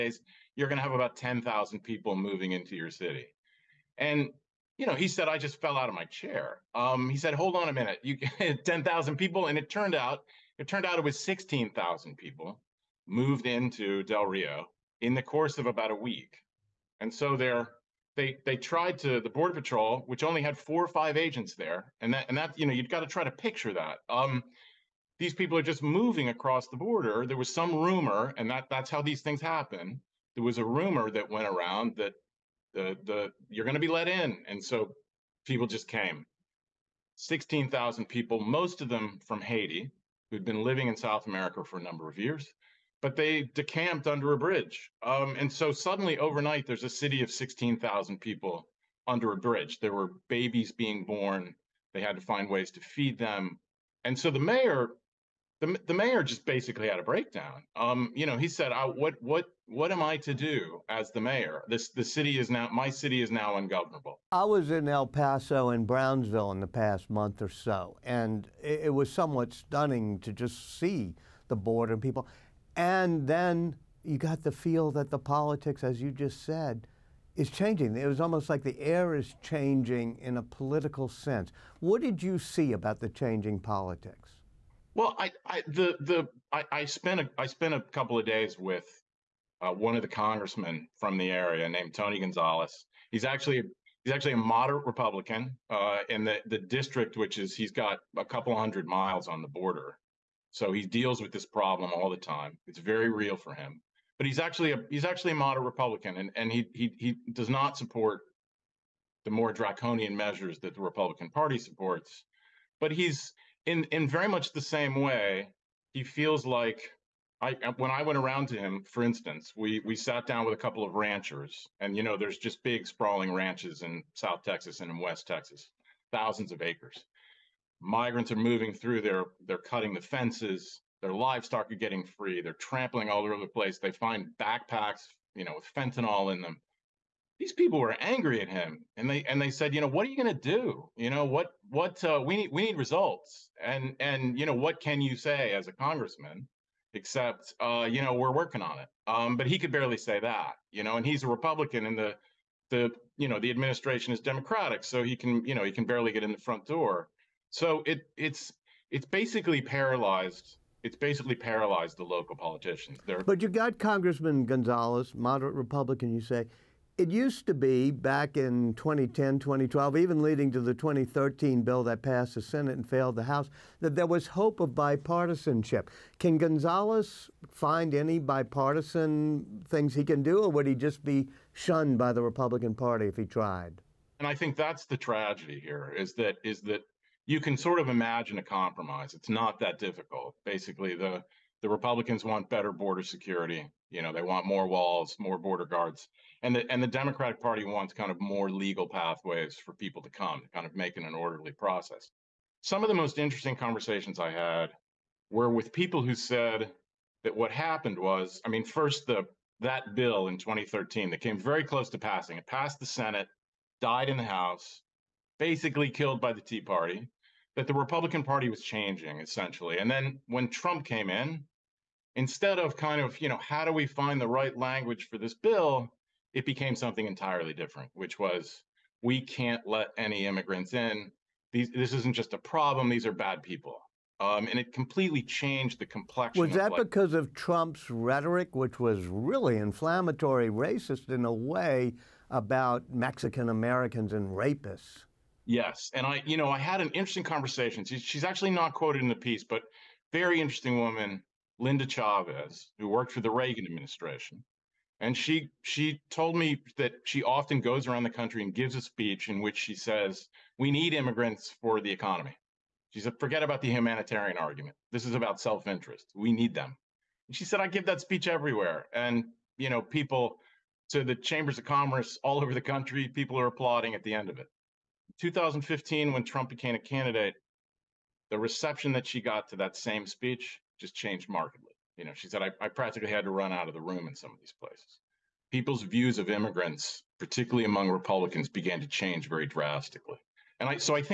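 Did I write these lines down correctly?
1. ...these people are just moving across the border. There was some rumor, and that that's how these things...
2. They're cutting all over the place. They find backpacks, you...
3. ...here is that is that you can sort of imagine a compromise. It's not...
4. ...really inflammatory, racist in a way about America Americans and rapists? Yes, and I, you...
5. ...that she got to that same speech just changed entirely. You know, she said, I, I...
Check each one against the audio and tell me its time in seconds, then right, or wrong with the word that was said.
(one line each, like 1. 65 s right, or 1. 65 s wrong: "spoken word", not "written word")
1. 25 s right
2. 132 s wrong: "trampling", not "cutting"
3. 185 s right
4. 239 s wrong: "Mexican", not "America"
5. 278 s wrong: "markedly", not "entirely".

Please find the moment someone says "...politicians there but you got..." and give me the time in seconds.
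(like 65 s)
162 s.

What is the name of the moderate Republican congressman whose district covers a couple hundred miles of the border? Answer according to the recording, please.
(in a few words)
Tony Gonzales.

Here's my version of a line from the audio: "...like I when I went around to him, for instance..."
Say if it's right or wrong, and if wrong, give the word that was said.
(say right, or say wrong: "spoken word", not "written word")
right.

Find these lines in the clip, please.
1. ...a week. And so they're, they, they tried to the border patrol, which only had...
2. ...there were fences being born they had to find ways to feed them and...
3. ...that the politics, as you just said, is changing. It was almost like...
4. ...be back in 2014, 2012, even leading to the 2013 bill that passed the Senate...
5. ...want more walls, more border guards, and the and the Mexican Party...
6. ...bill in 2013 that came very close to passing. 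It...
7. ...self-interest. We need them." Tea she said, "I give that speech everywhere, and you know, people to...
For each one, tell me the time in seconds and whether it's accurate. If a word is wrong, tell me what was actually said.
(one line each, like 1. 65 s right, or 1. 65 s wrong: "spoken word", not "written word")
1. 15 s right
2. 49 s wrong: "babies", not "fences"
3. 74 s right
4. 167 s wrong: "2010", not "2014"
5. 194 s wrong: "Democratic", not "Mexican"
6. 209 s right
7. 265 s wrong: "And", not "Tea".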